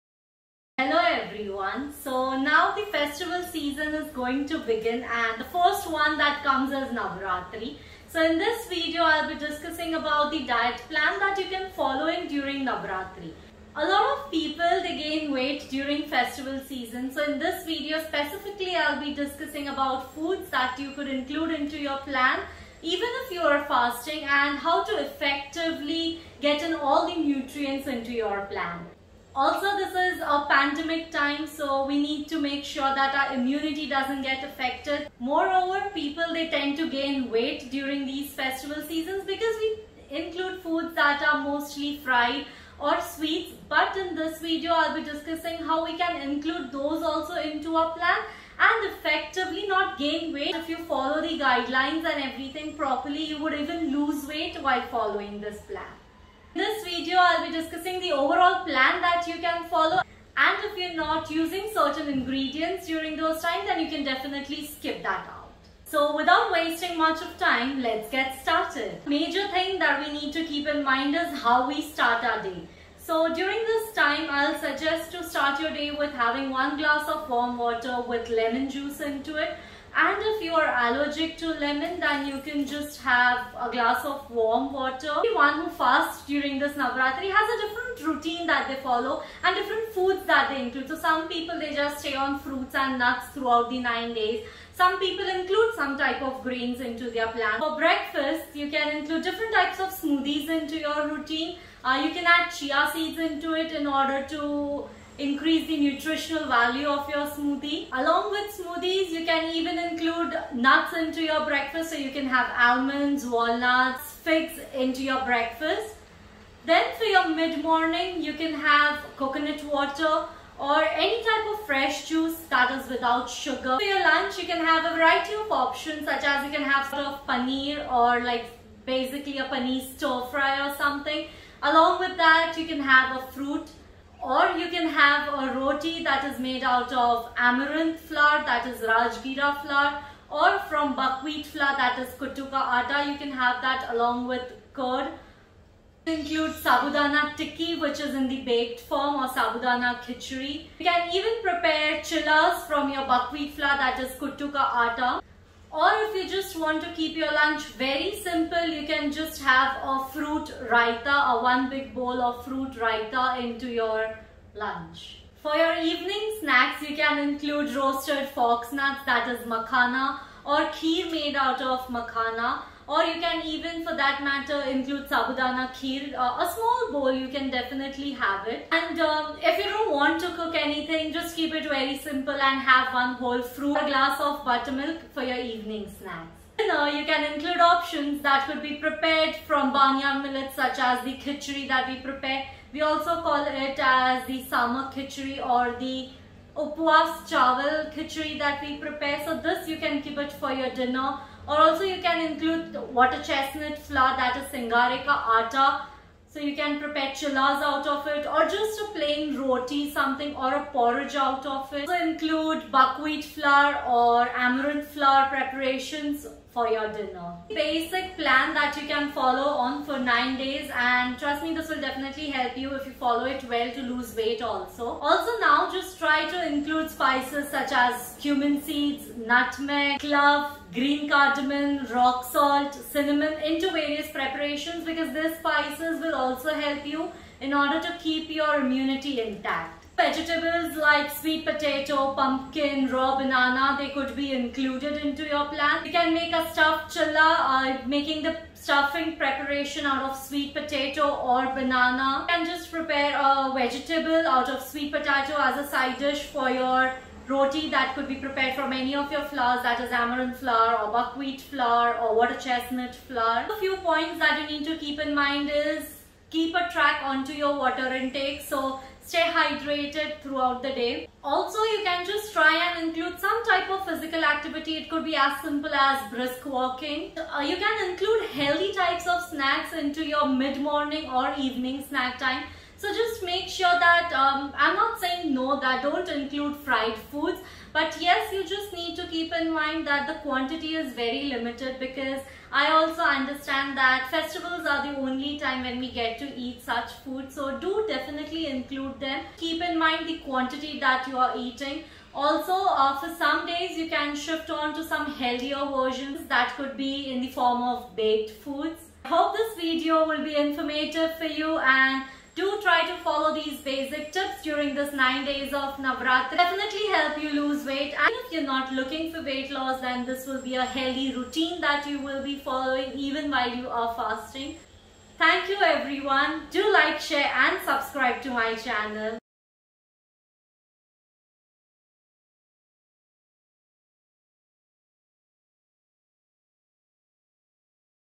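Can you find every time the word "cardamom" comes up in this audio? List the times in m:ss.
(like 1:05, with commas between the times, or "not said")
3:51.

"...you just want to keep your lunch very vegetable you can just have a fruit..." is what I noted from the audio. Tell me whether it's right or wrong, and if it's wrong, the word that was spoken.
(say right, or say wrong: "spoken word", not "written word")
wrong: "simple", not "vegetable".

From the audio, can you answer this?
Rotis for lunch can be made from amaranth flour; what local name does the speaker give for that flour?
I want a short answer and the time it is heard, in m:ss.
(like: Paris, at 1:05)
Rajgira flour, at 2:18.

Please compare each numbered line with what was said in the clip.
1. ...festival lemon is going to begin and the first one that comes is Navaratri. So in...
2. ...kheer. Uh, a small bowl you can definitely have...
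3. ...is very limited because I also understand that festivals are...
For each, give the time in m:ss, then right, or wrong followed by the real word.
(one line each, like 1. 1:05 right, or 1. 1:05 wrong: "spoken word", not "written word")
1. 0:02 wrong: "season", not "lemon"
2. 2:55 right
3. 4:50 right.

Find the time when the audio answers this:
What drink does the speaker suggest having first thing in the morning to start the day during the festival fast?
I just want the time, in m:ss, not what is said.
1:16.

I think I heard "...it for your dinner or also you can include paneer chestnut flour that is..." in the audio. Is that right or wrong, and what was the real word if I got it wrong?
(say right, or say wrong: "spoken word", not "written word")
wrong: "water", not "paneer".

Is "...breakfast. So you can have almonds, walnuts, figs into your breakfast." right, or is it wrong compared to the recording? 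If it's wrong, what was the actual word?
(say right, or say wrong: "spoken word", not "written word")
right.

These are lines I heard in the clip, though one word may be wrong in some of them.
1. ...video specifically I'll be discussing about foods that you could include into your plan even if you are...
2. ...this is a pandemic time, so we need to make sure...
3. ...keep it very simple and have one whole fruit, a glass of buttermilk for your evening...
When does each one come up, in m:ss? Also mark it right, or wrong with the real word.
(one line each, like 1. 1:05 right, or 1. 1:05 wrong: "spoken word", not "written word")
1. 0:17 right
2. 0:29 right
3. 3:01 right.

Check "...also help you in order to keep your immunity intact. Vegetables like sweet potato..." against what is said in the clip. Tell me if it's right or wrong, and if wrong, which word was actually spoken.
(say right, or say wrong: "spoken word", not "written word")
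right.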